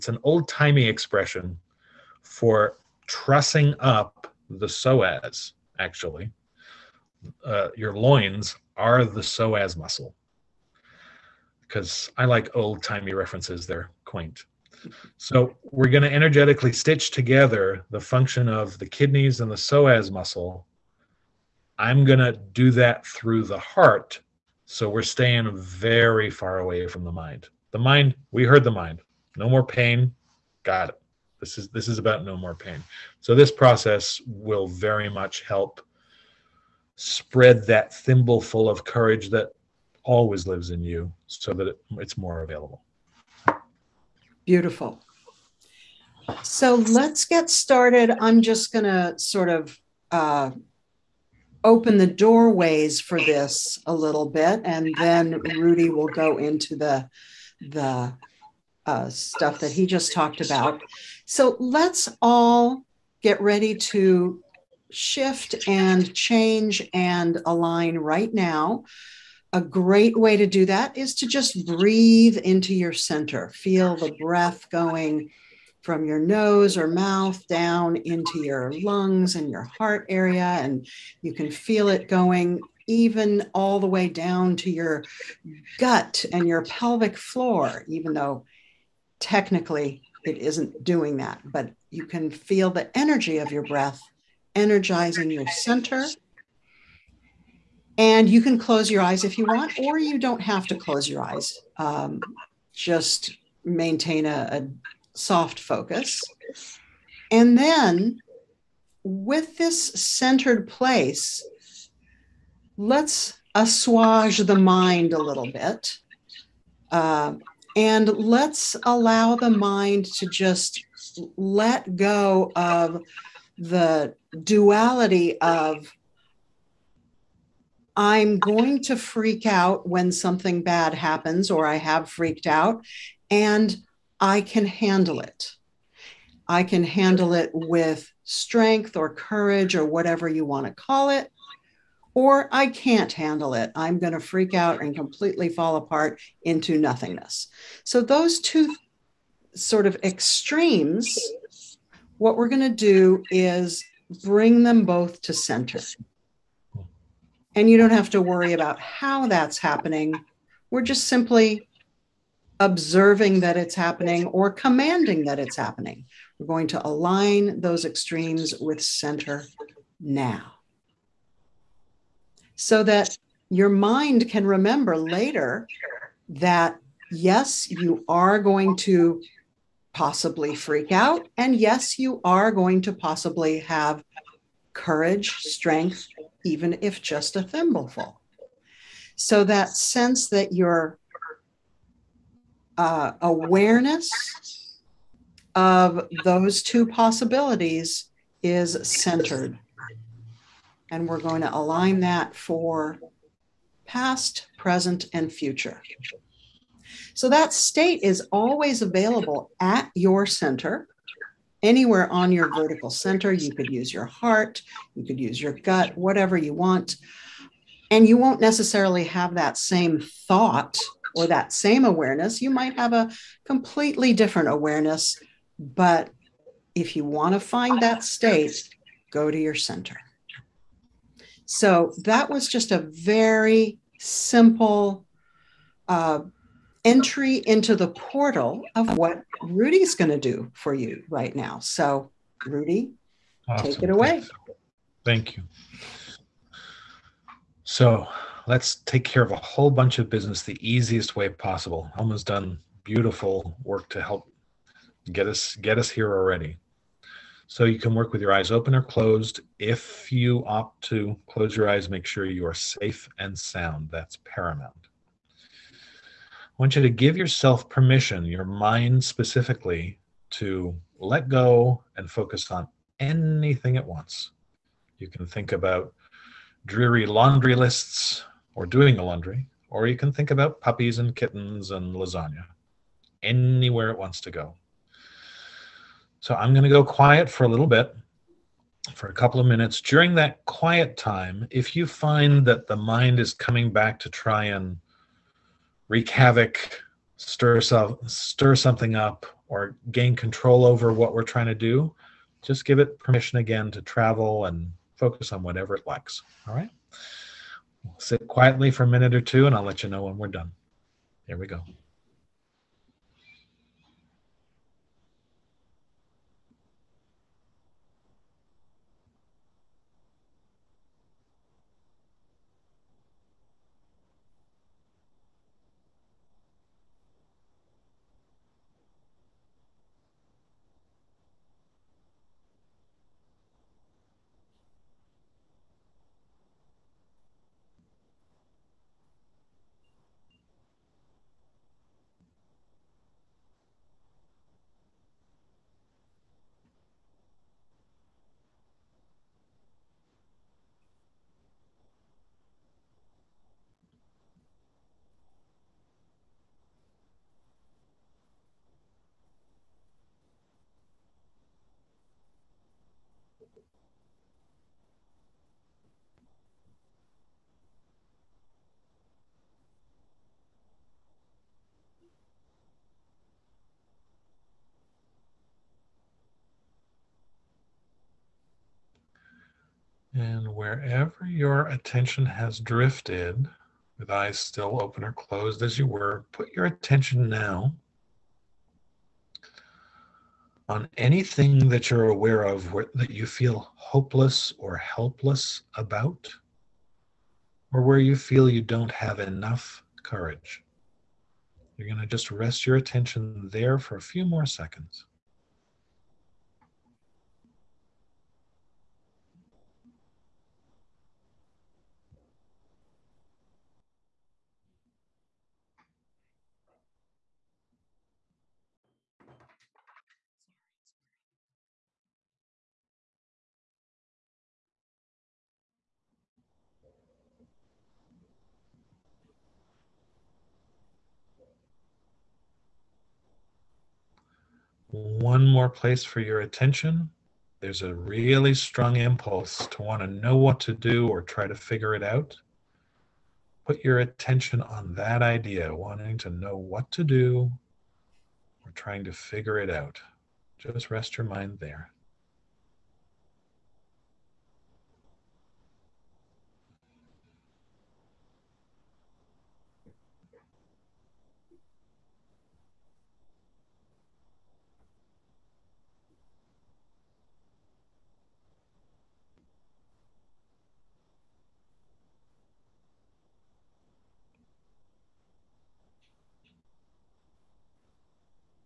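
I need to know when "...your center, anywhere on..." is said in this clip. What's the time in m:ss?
3:29.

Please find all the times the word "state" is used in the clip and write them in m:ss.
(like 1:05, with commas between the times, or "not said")
3:27, 3:48.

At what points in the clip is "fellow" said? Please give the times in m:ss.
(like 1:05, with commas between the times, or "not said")
not said.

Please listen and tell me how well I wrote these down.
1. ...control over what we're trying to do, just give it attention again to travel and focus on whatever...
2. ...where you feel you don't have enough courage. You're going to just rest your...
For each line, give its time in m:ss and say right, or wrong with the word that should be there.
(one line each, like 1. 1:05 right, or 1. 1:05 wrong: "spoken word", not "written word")
1. 5:00 wrong: "permission", not "attention"
2. 6:37 right.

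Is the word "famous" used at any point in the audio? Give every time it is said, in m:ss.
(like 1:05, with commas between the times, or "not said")
not said.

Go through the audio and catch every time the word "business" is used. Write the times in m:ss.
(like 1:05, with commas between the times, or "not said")
4:10.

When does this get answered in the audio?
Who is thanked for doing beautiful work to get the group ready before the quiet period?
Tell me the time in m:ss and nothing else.
4:11.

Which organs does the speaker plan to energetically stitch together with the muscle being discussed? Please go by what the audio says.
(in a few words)
kidneys.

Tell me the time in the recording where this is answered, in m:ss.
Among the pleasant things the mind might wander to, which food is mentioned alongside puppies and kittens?
4:41.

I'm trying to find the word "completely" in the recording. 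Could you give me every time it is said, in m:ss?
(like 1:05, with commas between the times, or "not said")
2:24, 3:43.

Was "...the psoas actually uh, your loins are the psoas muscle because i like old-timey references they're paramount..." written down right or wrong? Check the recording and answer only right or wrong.
wrong.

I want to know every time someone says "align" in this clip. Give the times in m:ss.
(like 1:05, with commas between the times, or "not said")
1:07, 2:46, 3:21.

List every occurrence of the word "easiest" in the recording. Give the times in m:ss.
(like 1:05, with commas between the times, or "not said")
4:10.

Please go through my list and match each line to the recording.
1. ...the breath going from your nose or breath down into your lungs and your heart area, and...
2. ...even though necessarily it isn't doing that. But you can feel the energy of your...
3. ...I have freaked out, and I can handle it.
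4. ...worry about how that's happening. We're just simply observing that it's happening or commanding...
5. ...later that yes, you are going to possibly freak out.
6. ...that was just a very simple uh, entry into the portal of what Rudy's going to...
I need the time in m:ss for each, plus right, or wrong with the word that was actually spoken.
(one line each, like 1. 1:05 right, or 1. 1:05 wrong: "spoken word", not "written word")
1. 1:13 wrong: "mouth", not "breath"
2. 1:27 wrong: "technically", not "necessarily"
3. 2:11 right
4. 2:38 right
5. 2:54 right
6. 3:52 right.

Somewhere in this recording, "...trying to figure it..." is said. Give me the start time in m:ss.
7:28.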